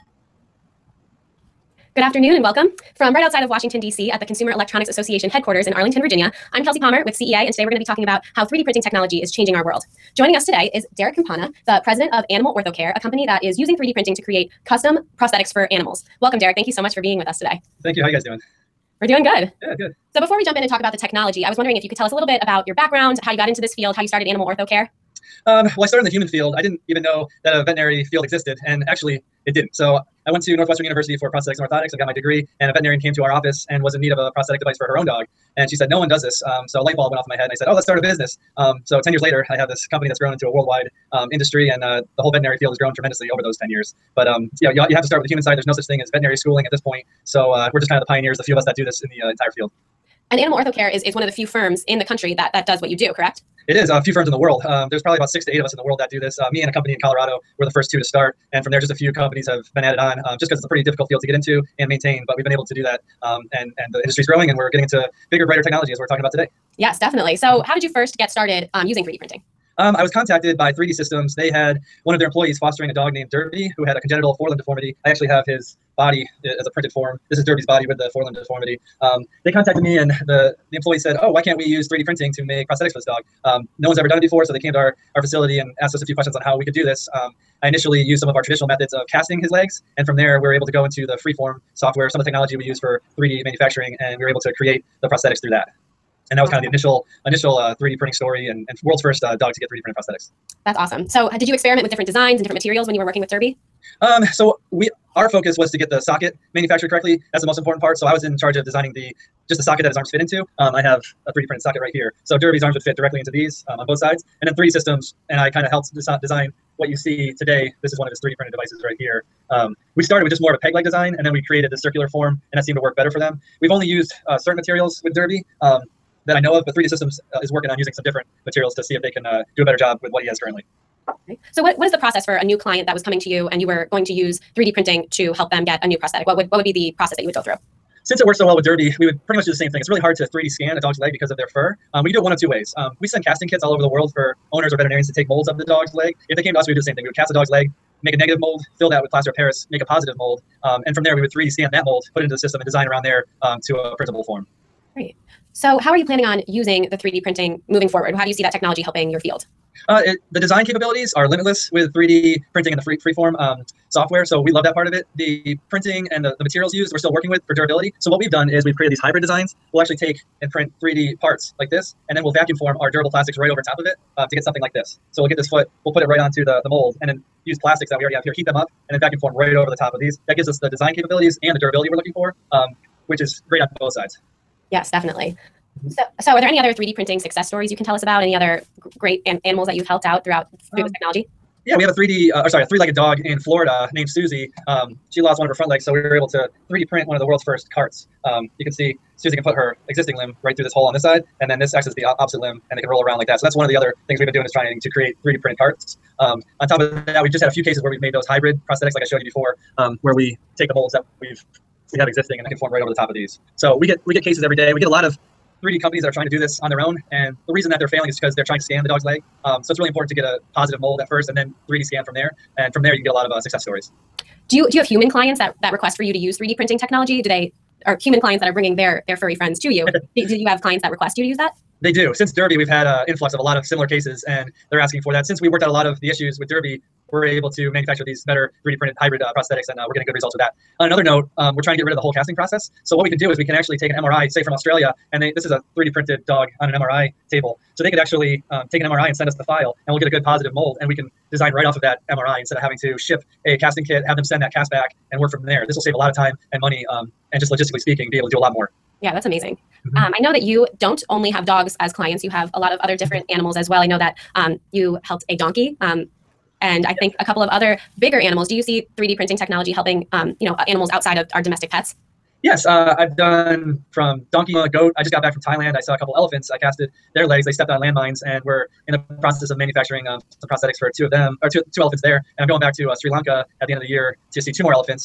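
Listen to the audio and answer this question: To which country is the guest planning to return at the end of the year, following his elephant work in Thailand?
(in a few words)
Sri Lanka.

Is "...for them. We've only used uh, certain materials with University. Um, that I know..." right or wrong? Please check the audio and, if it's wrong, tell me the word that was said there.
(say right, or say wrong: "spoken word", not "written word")
wrong: "Derby", not "University".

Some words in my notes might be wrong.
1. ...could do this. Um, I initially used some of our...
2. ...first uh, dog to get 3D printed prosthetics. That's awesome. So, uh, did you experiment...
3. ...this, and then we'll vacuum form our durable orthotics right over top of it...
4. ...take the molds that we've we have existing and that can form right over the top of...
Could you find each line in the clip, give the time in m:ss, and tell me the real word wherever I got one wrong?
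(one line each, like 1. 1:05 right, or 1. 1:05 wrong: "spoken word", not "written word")
1. 1:26 right
2. 1:39 right
3. 2:51 wrong: "plastics", not "orthotics"
4. 3:30 right.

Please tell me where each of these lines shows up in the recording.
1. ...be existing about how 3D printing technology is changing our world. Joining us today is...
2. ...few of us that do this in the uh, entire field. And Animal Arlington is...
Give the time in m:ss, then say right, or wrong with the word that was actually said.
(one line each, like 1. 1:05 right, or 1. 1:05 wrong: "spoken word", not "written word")
1. 0:07 wrong: "talking", not "existing"
2. 0:48 wrong: "Orthocare", not "Arlington".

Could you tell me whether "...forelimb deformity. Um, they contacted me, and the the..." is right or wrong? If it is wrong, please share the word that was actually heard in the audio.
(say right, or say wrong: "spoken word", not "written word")
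right.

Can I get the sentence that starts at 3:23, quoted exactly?
So that's one of the other things we've been doing is trying to create 3D printed carts.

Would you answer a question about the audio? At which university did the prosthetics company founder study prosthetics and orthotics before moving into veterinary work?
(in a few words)
Northwestern University.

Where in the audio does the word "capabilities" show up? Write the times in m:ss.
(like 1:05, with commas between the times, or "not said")
2:40, 3:00.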